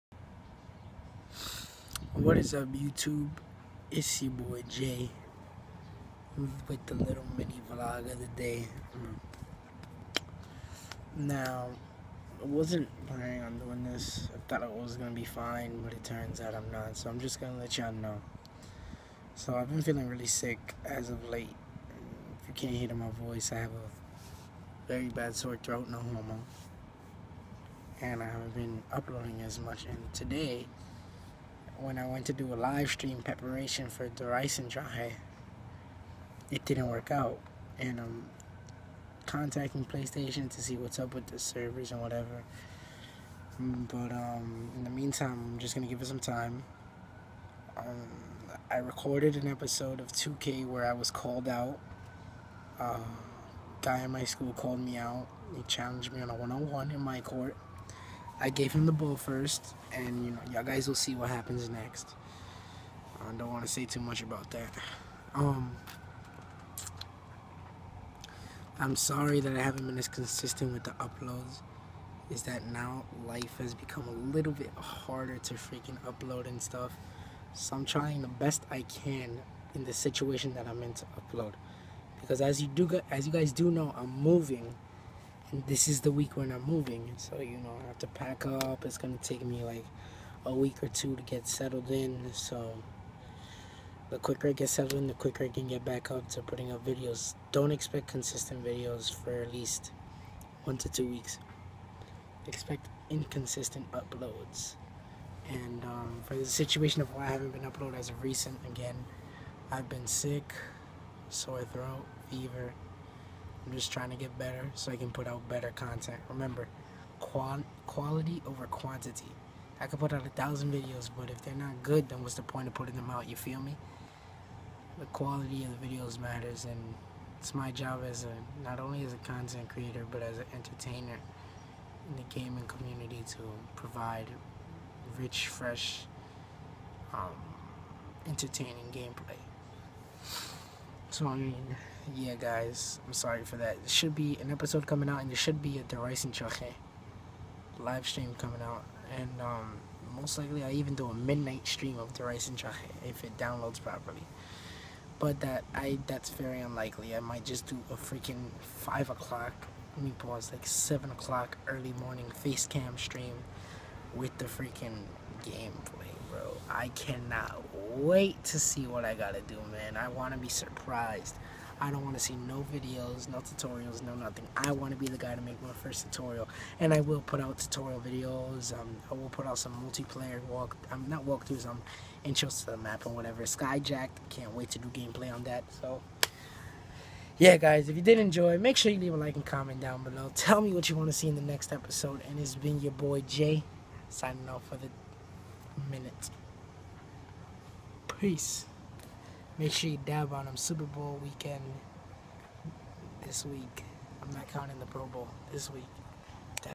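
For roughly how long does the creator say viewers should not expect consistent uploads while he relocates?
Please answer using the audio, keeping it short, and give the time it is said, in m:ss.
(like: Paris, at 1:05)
1 to 2 weeks, at 1:40.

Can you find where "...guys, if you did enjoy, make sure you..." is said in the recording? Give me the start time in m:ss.
3:07.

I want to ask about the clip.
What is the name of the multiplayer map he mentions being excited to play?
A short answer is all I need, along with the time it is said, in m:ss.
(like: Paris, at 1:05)
Skyjacked, at 3:03.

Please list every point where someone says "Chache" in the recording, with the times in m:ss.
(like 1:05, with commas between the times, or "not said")
2:26, 2:32.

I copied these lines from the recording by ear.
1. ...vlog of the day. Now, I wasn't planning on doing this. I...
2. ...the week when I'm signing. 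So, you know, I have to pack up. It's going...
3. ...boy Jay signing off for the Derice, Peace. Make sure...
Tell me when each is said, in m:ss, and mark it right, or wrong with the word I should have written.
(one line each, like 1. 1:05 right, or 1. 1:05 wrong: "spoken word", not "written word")
1. 0:07 right
2. 1:26 wrong: "moving", not "signing"
3. 3:12 wrong: "Minute", not "Derice".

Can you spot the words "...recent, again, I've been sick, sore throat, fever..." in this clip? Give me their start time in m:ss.
1:48.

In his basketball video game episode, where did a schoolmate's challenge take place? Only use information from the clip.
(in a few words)
In my court.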